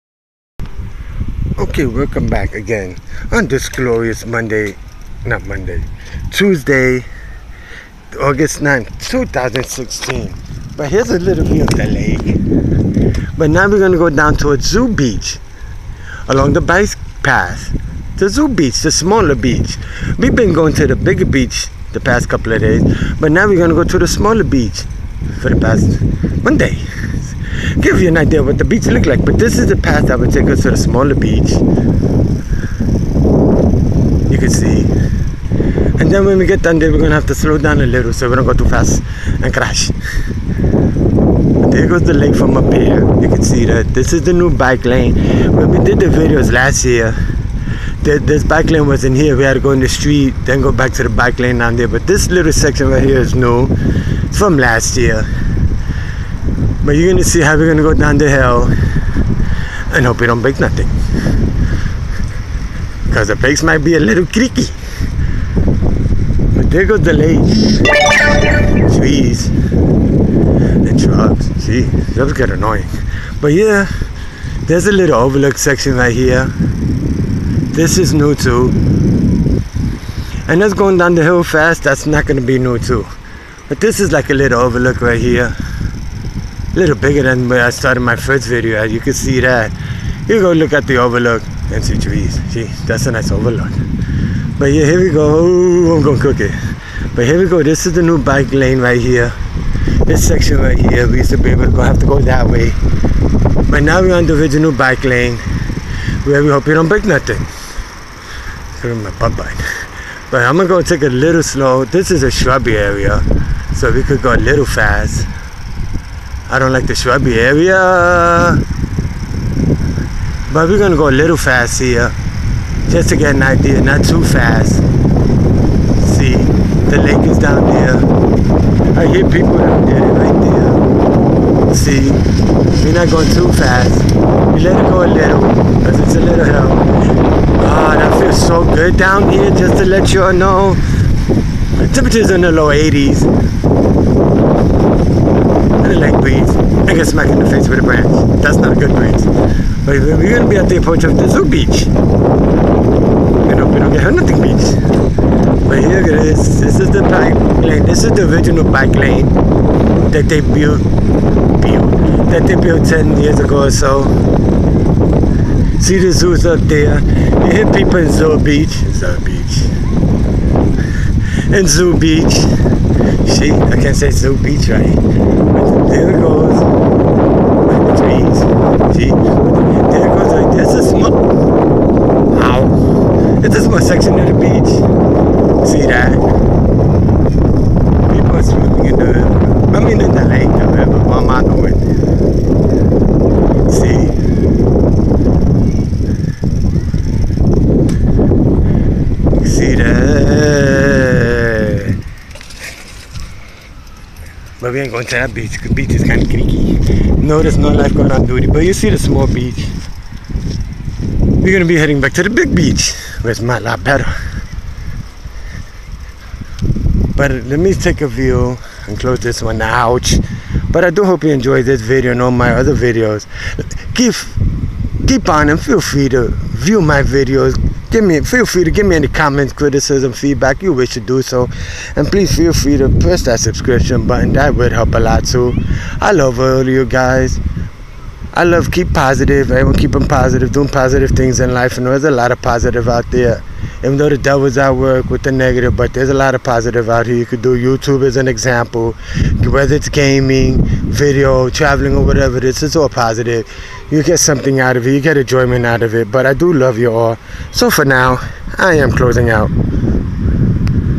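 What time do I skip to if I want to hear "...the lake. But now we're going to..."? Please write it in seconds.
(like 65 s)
11 s.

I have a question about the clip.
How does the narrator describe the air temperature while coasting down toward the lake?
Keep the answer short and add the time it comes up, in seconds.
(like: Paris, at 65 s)
low 80s, at 142 s.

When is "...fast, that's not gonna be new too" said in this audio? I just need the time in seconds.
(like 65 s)
81 s.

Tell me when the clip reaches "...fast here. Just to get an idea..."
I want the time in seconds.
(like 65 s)
121 s.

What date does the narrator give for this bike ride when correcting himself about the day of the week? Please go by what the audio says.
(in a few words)
August 9th, 2016.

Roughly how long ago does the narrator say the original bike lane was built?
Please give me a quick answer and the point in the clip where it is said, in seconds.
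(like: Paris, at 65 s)
10 years ago, at 162 s.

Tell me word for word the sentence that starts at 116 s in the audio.
I don't like the shrubby behavior.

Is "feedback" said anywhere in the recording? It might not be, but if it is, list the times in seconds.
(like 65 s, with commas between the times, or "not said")
230 s.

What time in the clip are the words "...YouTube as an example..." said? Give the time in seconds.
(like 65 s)
247 s.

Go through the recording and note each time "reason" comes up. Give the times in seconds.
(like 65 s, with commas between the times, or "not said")
not said.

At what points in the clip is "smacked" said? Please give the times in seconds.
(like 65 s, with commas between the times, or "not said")
147 s.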